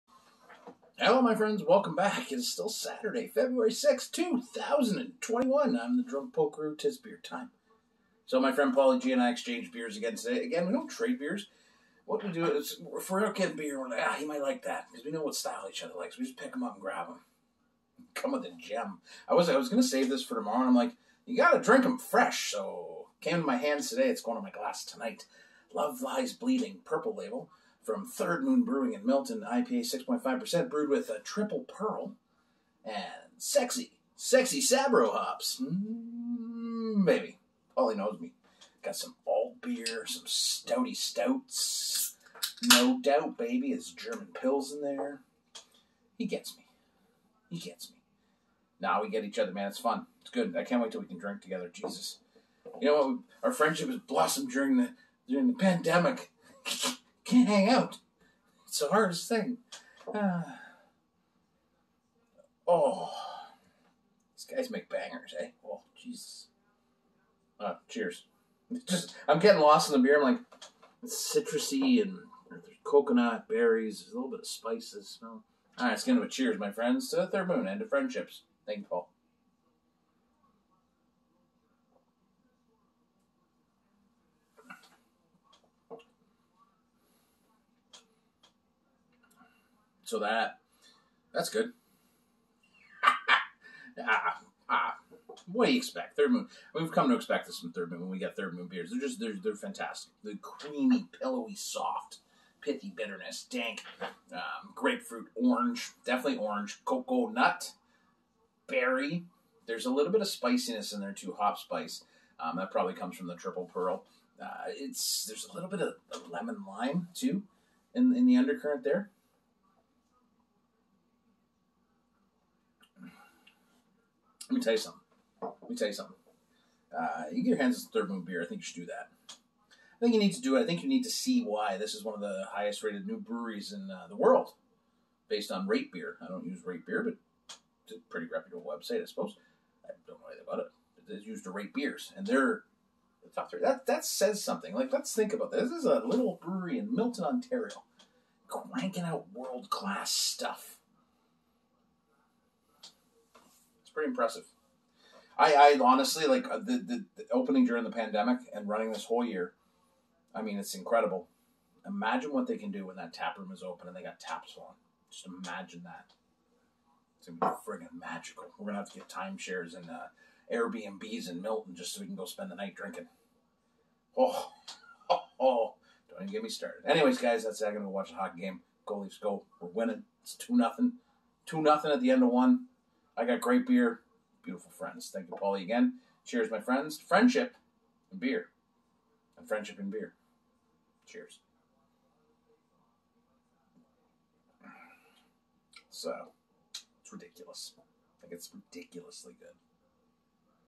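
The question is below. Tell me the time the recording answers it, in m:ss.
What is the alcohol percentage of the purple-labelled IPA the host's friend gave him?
0:30.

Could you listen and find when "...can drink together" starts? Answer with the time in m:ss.
0:51.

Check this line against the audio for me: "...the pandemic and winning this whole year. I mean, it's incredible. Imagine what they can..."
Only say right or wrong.
wrong.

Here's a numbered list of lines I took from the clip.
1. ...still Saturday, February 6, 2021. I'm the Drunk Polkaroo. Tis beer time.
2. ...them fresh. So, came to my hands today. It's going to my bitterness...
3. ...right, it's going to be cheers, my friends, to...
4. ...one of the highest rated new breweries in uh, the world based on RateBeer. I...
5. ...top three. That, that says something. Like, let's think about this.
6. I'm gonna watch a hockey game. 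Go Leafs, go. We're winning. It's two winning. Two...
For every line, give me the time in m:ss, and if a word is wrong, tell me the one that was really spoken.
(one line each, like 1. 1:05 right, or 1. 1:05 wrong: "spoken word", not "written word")
1. 0:02 right
2. 0:21 wrong: "glass", not "bitterness"
3. 1:15 right
4. 2:12 right
5. 2:23 right
6. 2:57 wrong: "nothing", not "winning".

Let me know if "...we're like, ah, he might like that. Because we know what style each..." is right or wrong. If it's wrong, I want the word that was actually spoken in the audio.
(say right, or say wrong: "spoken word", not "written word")
right.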